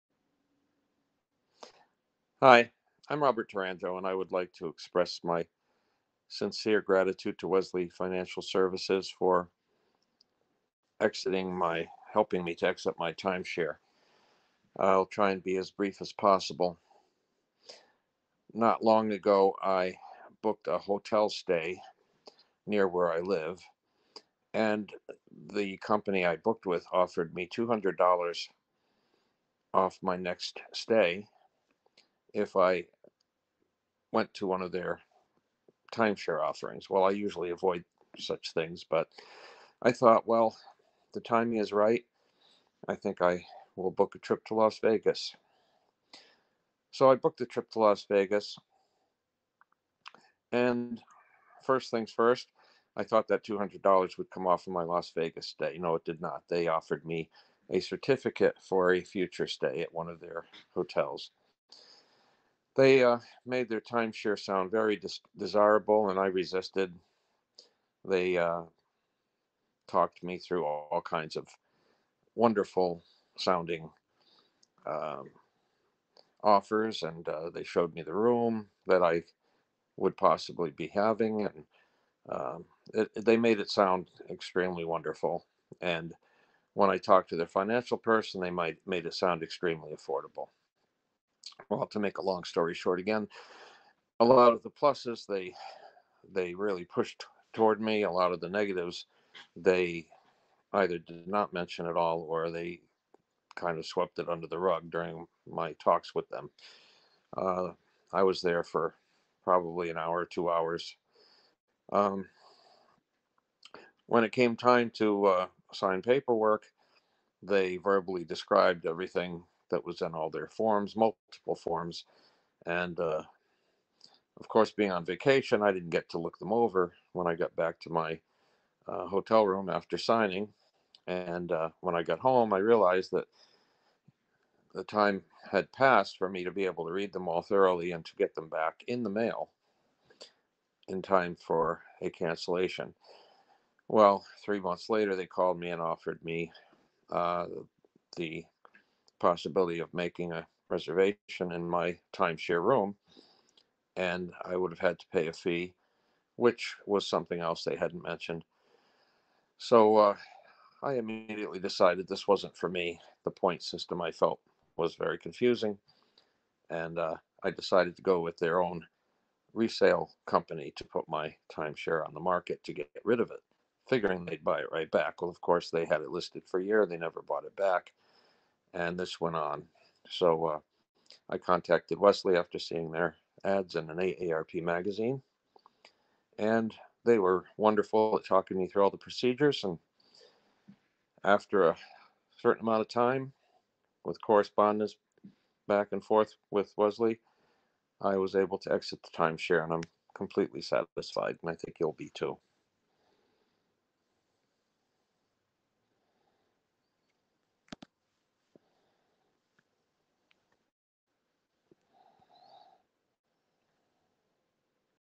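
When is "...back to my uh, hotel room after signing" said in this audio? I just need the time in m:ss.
2:07.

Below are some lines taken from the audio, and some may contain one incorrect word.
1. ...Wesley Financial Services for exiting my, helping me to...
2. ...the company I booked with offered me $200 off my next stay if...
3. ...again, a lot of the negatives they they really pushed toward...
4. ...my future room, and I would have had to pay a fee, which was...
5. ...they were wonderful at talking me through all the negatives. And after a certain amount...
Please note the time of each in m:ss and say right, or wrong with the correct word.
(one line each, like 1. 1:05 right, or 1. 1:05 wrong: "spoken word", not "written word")
1. 0:07 right
2. 0:25 right
3. 1:32 wrong: "pluses", not "negatives"
4. 2:31 wrong: "timeshare", not "future"
5. 3:07 wrong: "procedures", not "negatives".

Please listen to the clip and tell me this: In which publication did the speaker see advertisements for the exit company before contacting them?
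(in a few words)
AARP magazine.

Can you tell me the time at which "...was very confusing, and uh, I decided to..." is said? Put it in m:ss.
2:44.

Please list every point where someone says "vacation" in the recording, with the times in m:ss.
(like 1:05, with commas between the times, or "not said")
2:05.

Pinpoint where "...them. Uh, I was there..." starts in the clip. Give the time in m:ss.
1:46.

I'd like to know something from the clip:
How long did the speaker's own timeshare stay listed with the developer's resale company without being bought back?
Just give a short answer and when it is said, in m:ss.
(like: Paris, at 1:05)
a year, at 2:56.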